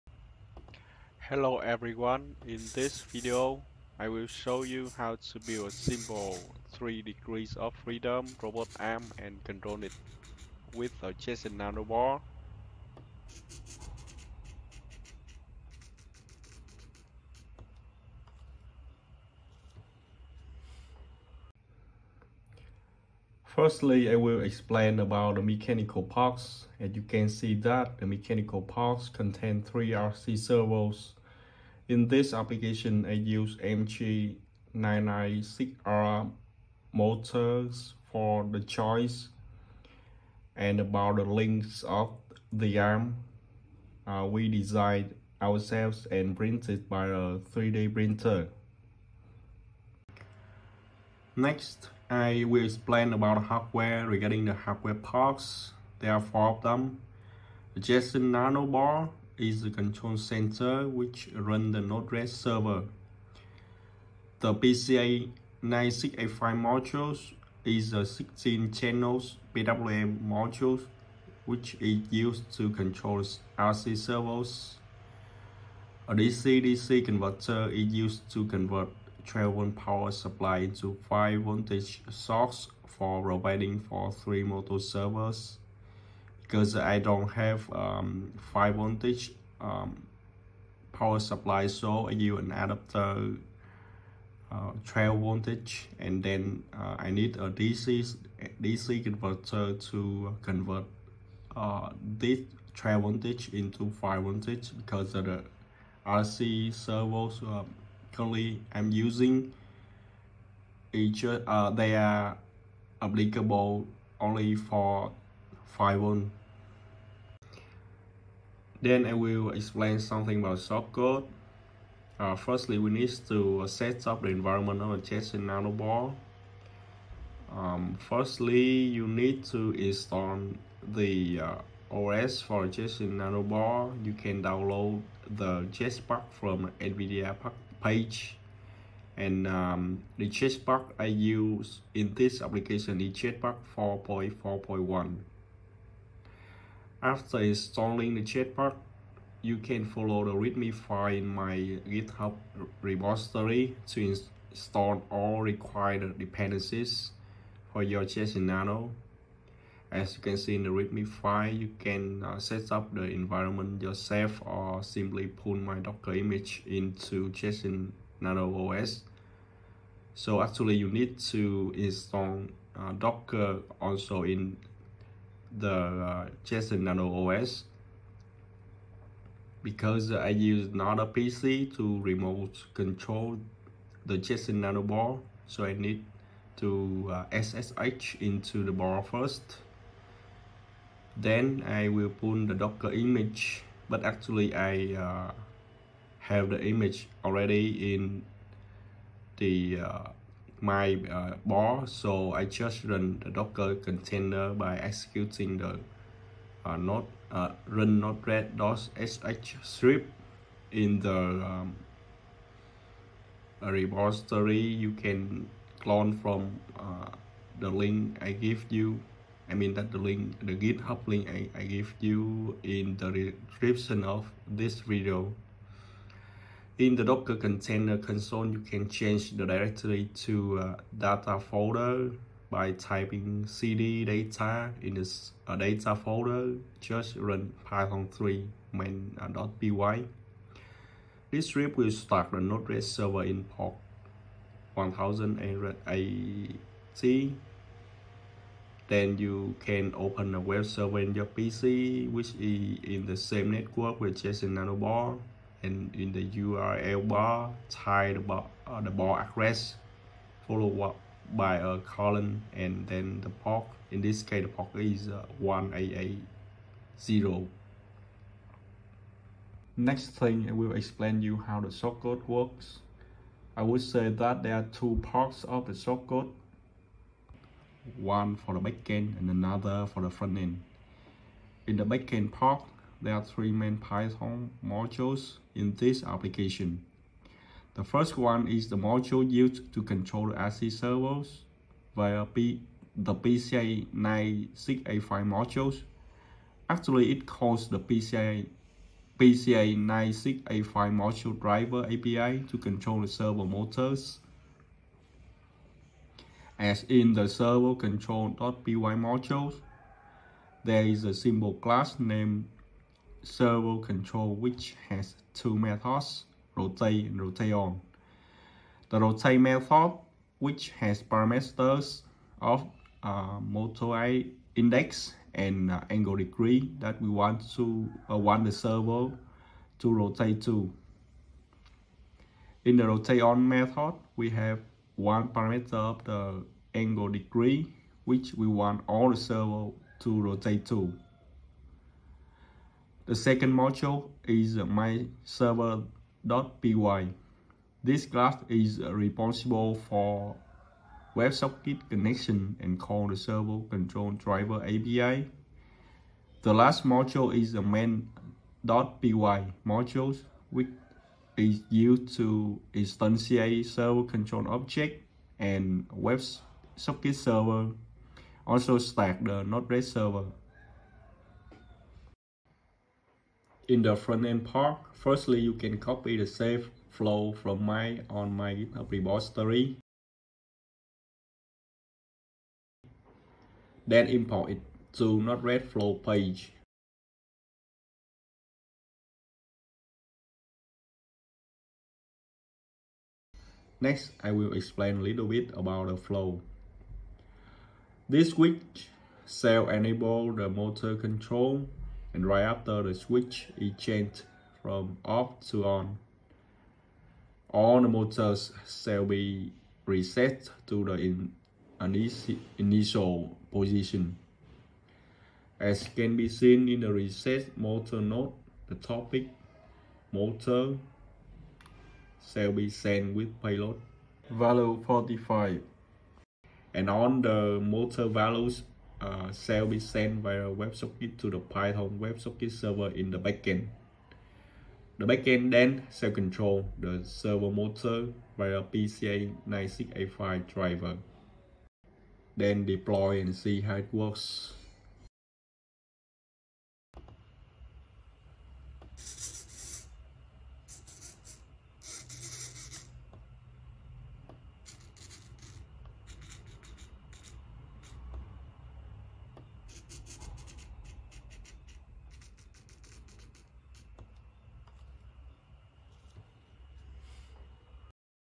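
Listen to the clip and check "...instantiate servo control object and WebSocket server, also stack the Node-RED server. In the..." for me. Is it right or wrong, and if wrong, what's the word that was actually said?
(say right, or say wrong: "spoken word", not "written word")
right.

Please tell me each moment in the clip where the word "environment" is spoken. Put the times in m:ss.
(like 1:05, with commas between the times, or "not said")
2:04, 2:43.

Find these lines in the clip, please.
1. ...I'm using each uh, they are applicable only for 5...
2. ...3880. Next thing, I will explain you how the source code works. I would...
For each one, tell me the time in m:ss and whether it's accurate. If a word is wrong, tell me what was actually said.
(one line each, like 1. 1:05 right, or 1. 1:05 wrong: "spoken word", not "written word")
1. 1:48 right
2. 4:25 wrong: "1880", not "3880".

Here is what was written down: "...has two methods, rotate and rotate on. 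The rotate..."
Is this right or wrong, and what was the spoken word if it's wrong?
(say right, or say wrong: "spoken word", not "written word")
right.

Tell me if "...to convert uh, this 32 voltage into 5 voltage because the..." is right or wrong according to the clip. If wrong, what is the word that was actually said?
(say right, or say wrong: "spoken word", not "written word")
wrong: "12", not "32".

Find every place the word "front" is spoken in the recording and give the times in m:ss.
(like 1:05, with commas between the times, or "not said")
4:40, 6:13.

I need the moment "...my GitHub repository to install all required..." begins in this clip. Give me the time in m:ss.
2:31.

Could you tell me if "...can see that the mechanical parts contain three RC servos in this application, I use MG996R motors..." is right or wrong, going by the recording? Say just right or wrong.
right.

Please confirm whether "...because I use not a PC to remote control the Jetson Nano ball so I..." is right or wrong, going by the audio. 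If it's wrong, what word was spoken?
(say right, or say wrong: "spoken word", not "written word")
right.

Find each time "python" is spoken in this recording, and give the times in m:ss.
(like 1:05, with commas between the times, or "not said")
3:57, 4:43, 7:11.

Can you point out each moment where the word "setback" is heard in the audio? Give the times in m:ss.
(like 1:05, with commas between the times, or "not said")
not said.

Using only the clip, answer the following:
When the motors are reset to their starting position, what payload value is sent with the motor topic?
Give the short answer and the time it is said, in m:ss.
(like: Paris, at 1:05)
45, at 7:04.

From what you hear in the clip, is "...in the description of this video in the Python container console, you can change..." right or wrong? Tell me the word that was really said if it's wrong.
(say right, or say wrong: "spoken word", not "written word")
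wrong: "Docker", not "Python".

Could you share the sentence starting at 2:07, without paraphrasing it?
Um, firstly, you need to install the uh, OS for in nanoball.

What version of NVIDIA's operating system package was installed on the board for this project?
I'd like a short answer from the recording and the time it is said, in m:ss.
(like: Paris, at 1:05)
JetPack 4.4.1, at 2:23.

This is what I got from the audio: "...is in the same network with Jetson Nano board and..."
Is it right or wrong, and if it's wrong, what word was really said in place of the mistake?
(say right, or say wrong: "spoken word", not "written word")
right.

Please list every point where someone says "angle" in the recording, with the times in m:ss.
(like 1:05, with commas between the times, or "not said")
5:25, 5:36.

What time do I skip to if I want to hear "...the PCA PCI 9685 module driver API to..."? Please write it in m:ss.
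4:57.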